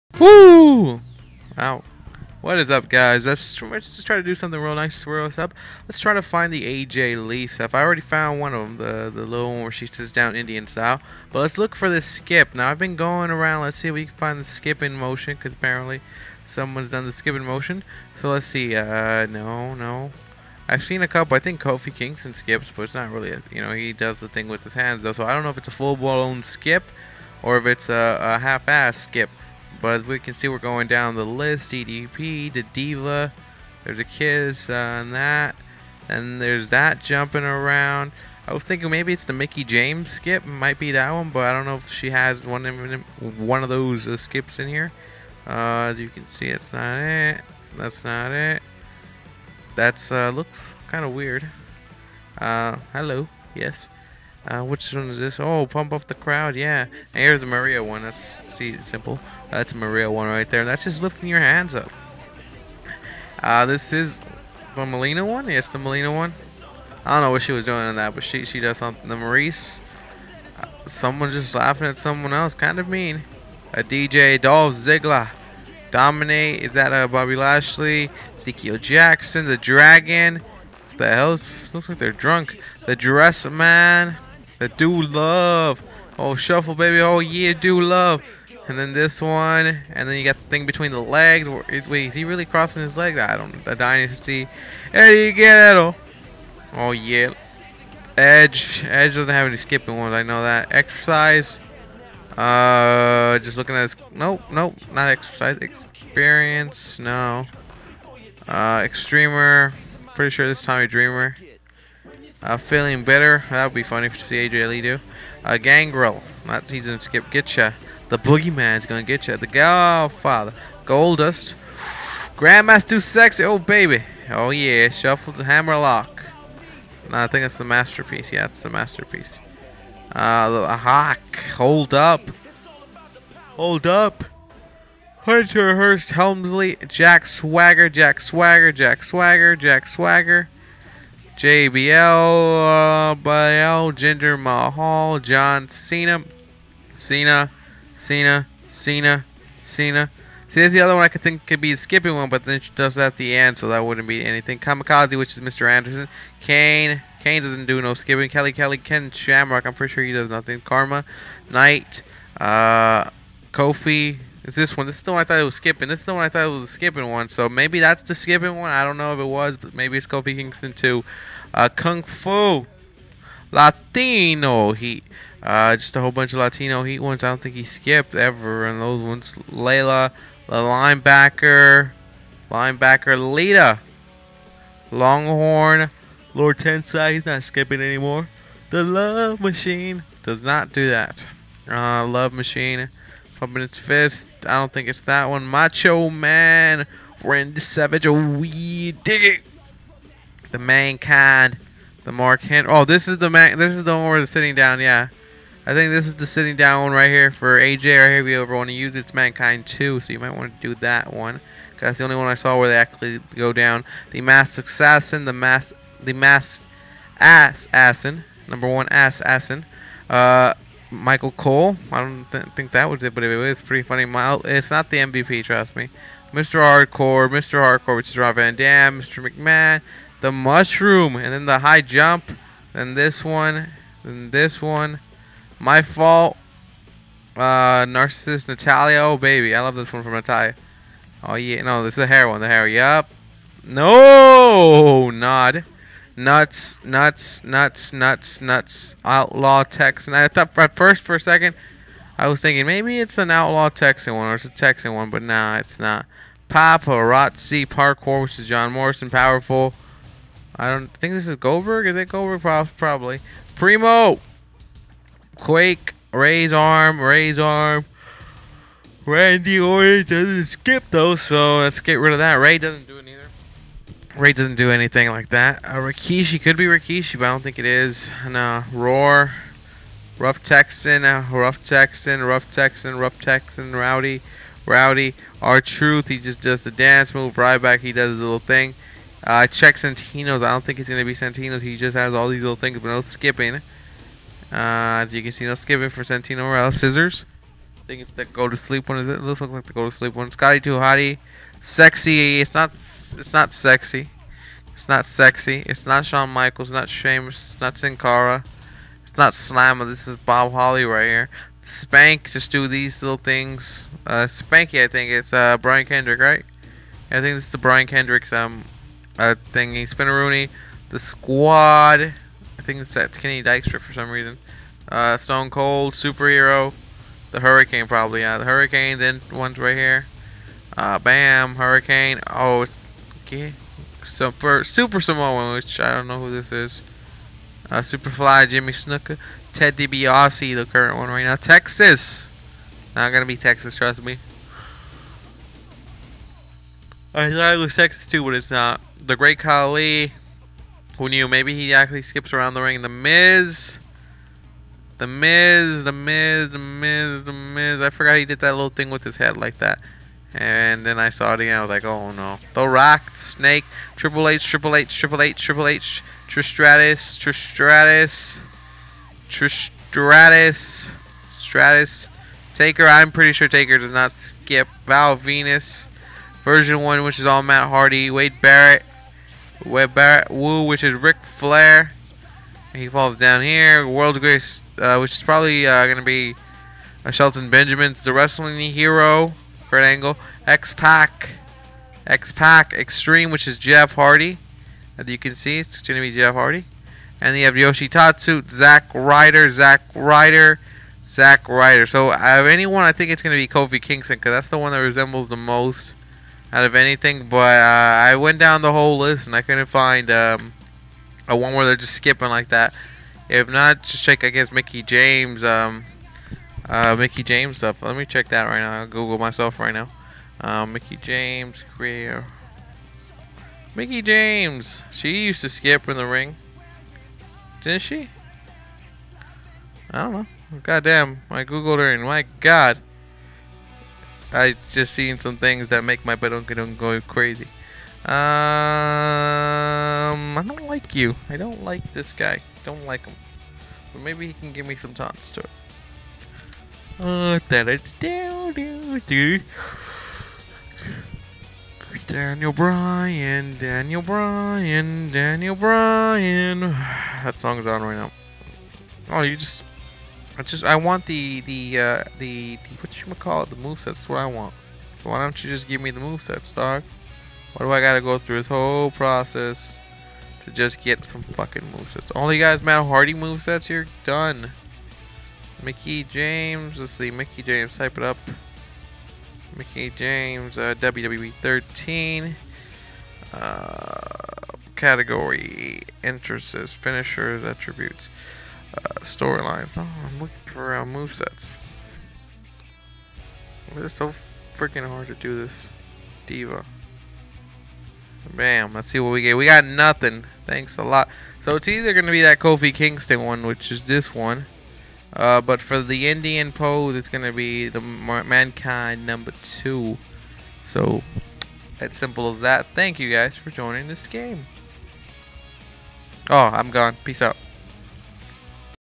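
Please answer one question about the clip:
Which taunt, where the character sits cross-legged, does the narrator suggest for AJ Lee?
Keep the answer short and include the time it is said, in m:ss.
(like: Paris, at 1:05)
Mankind 2, at 3:29.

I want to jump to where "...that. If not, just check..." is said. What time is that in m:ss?
6:52.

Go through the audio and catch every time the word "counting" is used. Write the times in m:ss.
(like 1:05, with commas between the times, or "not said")
not said.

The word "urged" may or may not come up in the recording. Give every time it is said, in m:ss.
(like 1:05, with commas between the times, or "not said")
not said.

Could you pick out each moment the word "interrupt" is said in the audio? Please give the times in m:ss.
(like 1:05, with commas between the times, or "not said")
not said.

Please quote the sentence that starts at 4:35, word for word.
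Uh, Rikishi could be Rikishi, but I don't think it is.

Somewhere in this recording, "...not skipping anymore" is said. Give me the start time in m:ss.
3:07.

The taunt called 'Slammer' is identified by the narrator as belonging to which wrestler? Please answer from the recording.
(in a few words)
Bob Holly.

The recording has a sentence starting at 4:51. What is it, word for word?
He just has all these little things, but no skipping.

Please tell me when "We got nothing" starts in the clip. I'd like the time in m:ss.
8:19.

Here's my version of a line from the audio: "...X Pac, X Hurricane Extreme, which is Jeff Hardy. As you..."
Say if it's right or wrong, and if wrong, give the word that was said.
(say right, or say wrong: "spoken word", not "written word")
wrong: "Pac", not "Hurricane".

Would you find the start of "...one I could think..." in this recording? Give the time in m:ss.
2:30.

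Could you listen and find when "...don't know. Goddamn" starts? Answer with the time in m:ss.
7:10.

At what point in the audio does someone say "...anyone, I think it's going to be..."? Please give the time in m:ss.
6:42.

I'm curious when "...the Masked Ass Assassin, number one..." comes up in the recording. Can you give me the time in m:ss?
3:36.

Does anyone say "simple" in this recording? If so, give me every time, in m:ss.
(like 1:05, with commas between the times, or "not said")
0:58, 8:31.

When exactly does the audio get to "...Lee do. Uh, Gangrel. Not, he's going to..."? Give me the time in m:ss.
1:54.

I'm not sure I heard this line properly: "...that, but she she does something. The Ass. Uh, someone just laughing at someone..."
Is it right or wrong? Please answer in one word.
wrong.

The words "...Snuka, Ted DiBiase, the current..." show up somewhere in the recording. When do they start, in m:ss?
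5:38.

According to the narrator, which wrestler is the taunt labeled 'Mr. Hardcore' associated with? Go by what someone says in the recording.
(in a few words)
Rob Van Dam.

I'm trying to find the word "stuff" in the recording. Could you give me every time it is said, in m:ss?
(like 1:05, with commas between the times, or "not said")
0:07, 6:57.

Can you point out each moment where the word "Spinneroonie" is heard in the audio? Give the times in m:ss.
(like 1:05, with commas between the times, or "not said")
5:19.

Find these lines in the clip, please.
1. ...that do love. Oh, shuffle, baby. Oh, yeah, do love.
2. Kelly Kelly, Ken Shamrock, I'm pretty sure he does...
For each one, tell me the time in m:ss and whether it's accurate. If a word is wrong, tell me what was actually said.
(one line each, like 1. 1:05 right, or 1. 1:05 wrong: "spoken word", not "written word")
1. 1:24 right
2. 2:38 right.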